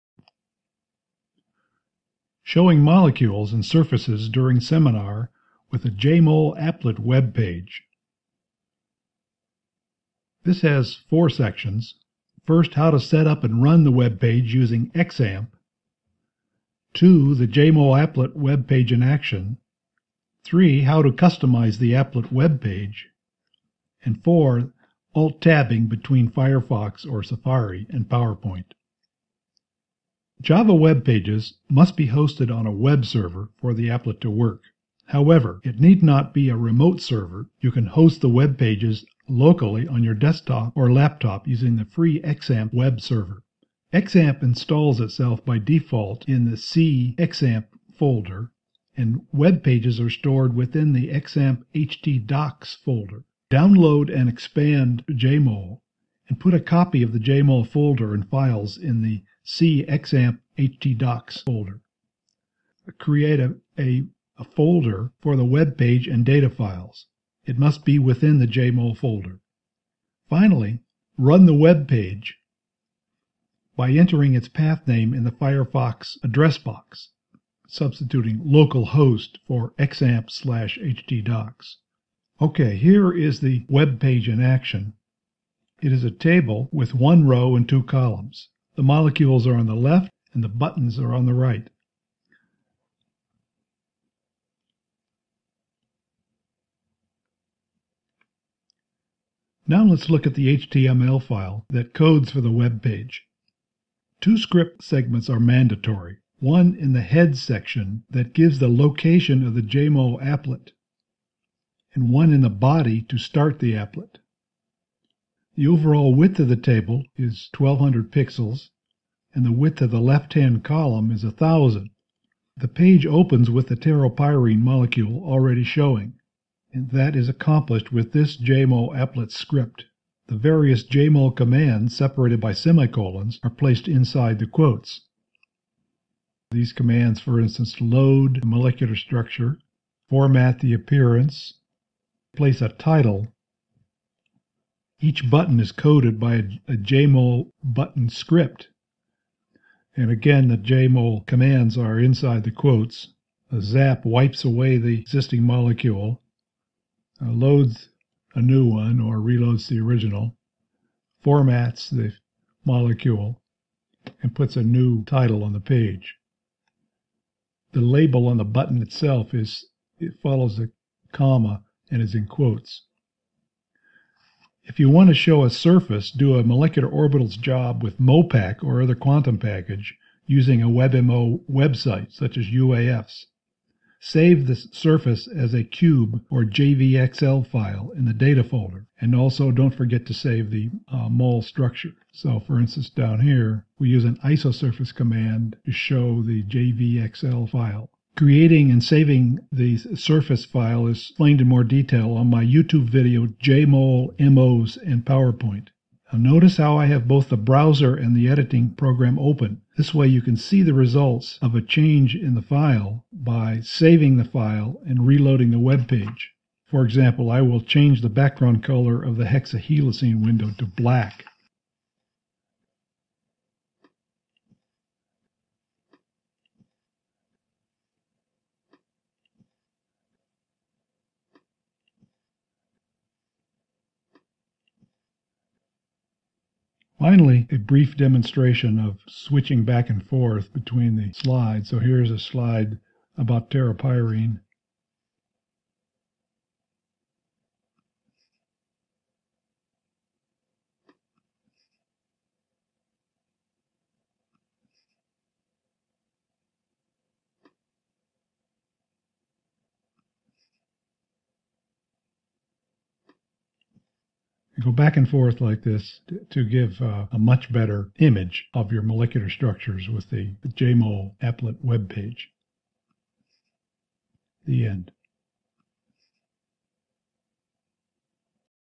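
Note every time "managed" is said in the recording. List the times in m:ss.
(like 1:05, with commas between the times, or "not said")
not said.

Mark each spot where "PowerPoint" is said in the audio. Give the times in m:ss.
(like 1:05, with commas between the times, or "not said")
0:28, 3:25.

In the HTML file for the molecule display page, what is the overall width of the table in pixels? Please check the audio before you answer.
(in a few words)
1200.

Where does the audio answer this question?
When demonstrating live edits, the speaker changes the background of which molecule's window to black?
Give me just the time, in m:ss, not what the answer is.
3:39.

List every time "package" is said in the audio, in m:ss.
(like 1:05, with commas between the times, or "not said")
2:59.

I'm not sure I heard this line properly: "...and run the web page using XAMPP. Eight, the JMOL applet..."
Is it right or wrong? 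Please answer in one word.
wrong.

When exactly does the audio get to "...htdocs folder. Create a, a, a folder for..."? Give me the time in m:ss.
0:59.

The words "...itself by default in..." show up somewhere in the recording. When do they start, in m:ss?
0:44.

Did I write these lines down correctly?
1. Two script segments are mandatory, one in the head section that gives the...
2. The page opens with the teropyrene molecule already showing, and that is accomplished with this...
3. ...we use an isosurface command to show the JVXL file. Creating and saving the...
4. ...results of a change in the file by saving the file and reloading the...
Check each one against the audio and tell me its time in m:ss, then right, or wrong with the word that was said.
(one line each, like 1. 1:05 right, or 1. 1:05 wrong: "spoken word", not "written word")
1. 1:44 right
2. 2:02 right
3. 3:13 right
4. 3:30 right.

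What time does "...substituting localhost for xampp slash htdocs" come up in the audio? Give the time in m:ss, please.
1:17.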